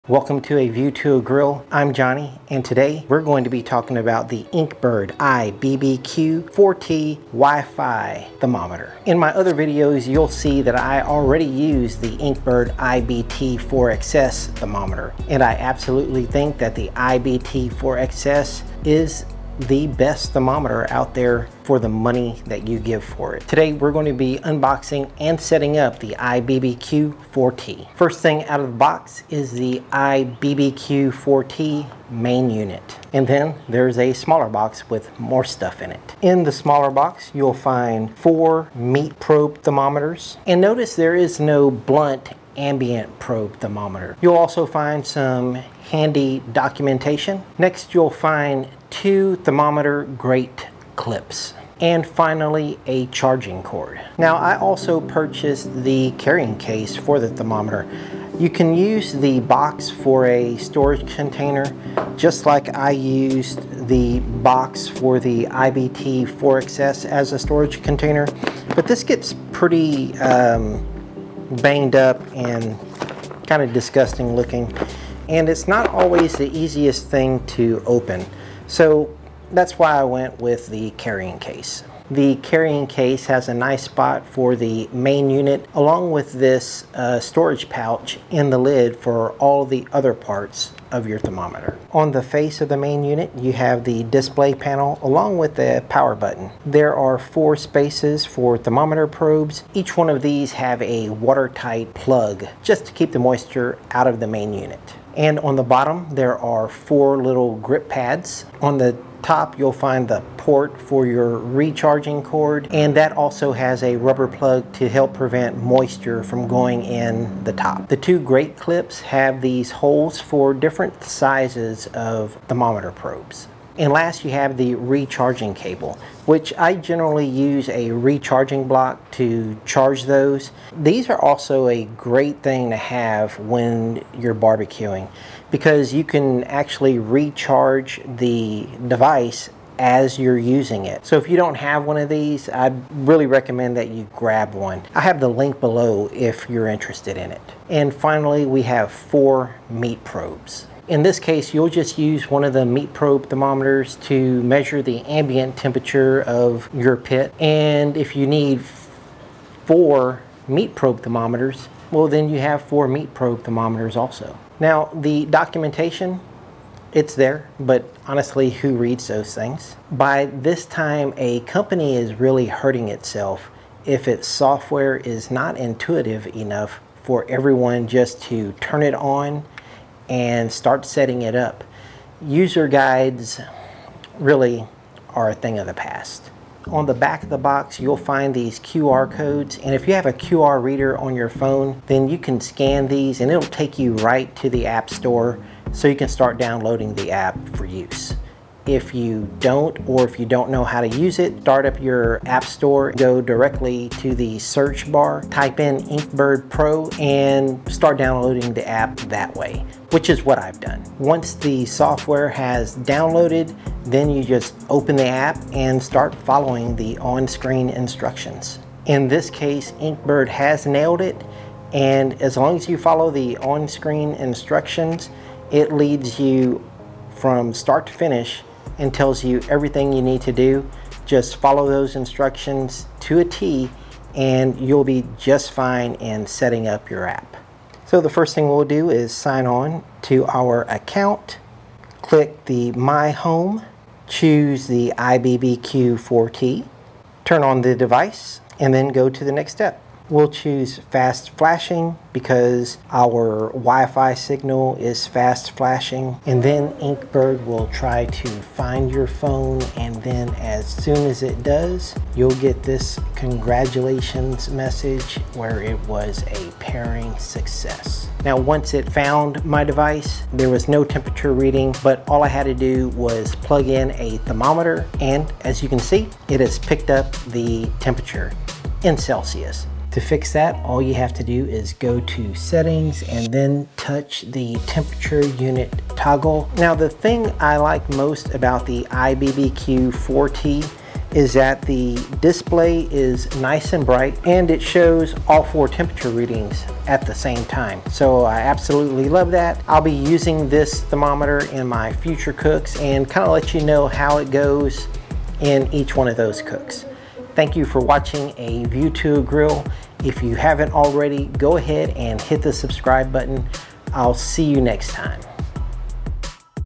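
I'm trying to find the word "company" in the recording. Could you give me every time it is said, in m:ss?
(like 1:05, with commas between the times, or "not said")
2:51.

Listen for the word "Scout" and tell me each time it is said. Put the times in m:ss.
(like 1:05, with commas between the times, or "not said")
not said.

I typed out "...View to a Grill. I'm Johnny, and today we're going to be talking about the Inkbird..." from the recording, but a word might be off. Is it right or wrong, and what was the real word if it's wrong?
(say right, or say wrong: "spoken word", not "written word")
right.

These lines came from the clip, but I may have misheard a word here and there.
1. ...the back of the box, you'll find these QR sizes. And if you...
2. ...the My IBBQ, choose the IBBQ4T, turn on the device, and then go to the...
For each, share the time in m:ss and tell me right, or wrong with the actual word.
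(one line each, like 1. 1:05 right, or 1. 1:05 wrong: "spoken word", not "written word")
1. 3:06 wrong: "codes", not "sizes"
2. 4:02 wrong: "Home", not "IBBQ".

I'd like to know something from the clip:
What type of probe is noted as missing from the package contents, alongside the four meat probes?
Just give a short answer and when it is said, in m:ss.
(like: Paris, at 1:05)
Blunt ambient probe, at 0:41.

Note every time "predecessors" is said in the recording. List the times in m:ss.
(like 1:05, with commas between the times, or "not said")
not said.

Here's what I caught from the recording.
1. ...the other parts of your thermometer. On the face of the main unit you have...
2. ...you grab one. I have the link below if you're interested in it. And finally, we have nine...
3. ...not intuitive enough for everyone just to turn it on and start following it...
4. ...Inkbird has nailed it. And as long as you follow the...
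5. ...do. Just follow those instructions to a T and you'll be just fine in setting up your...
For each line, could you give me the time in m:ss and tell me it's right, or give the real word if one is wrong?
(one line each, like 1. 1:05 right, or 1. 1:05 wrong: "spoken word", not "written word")
1. 1:29 right
2. 2:23 wrong: "four", not "nine"
3. 2:55 wrong: "setting", not "following"
4. 3:39 right
5. 3:50 right.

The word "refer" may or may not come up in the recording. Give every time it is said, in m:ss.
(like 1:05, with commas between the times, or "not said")
not said.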